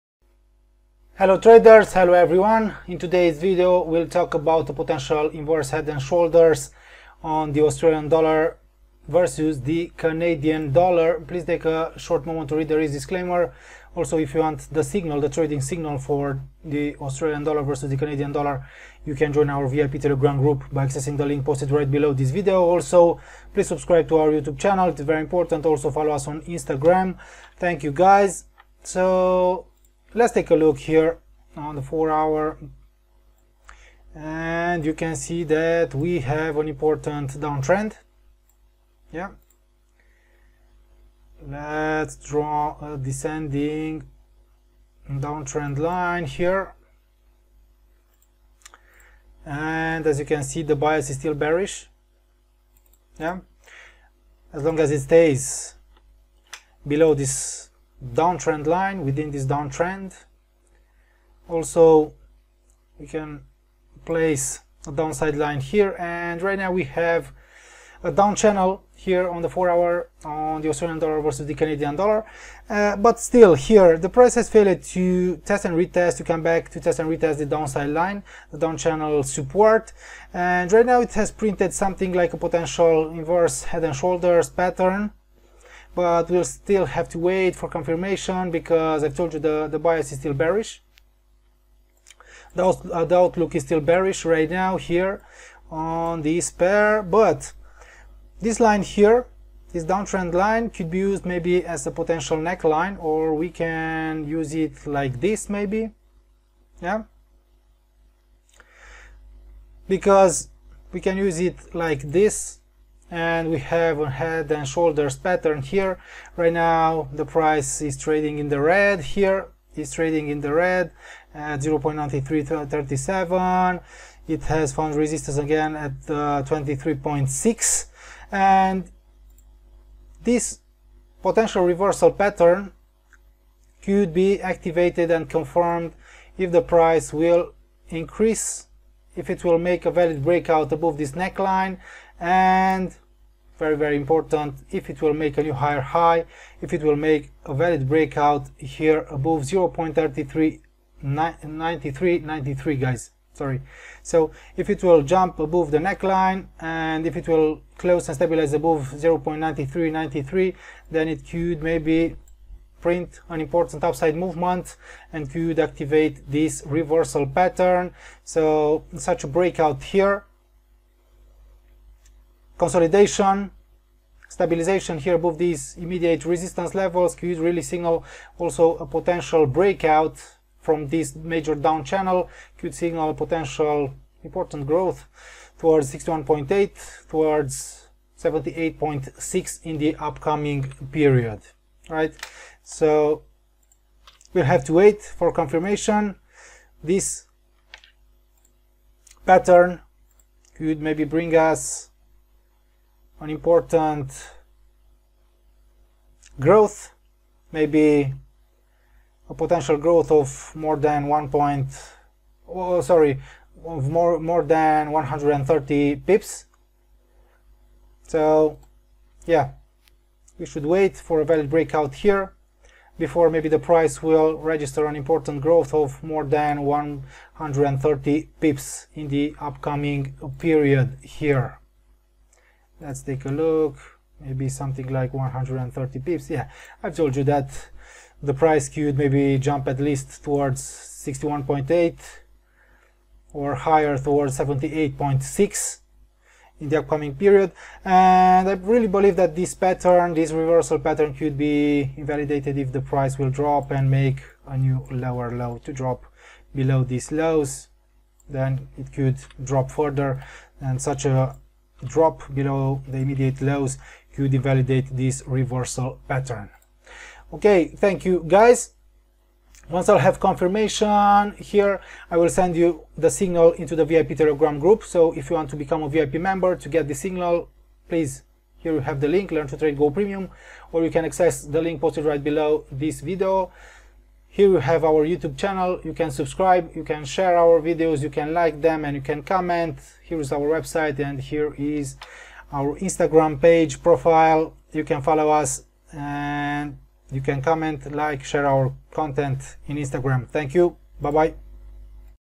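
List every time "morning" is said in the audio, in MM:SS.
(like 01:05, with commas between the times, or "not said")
not said.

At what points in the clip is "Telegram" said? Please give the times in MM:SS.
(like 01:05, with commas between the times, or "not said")
00:20, 04:34.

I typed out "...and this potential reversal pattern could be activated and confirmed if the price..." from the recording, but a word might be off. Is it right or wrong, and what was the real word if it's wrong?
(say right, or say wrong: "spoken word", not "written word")
right.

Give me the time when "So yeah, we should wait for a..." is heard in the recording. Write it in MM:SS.
03:38.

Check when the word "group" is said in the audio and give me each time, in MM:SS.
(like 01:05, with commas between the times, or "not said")
00:20, 04:34.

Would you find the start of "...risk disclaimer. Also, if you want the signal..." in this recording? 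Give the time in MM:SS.
00:12.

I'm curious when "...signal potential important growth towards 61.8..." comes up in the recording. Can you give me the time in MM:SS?
03:02.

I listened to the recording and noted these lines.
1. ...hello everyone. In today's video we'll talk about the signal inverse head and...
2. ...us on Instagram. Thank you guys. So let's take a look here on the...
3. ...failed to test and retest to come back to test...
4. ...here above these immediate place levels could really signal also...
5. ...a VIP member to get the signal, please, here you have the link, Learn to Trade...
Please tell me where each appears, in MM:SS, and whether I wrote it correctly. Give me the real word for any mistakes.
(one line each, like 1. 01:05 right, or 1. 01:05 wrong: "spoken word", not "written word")
1. 00:01 wrong: "potential", not "signal"
2. 00:26 right
3. 01:14 right
4. 02:54 wrong: "resistance", not "place"
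5. 04:35 right.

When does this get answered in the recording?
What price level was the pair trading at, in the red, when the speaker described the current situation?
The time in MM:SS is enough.
02:01.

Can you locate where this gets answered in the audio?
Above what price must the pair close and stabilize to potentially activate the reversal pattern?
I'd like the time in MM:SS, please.
02:38.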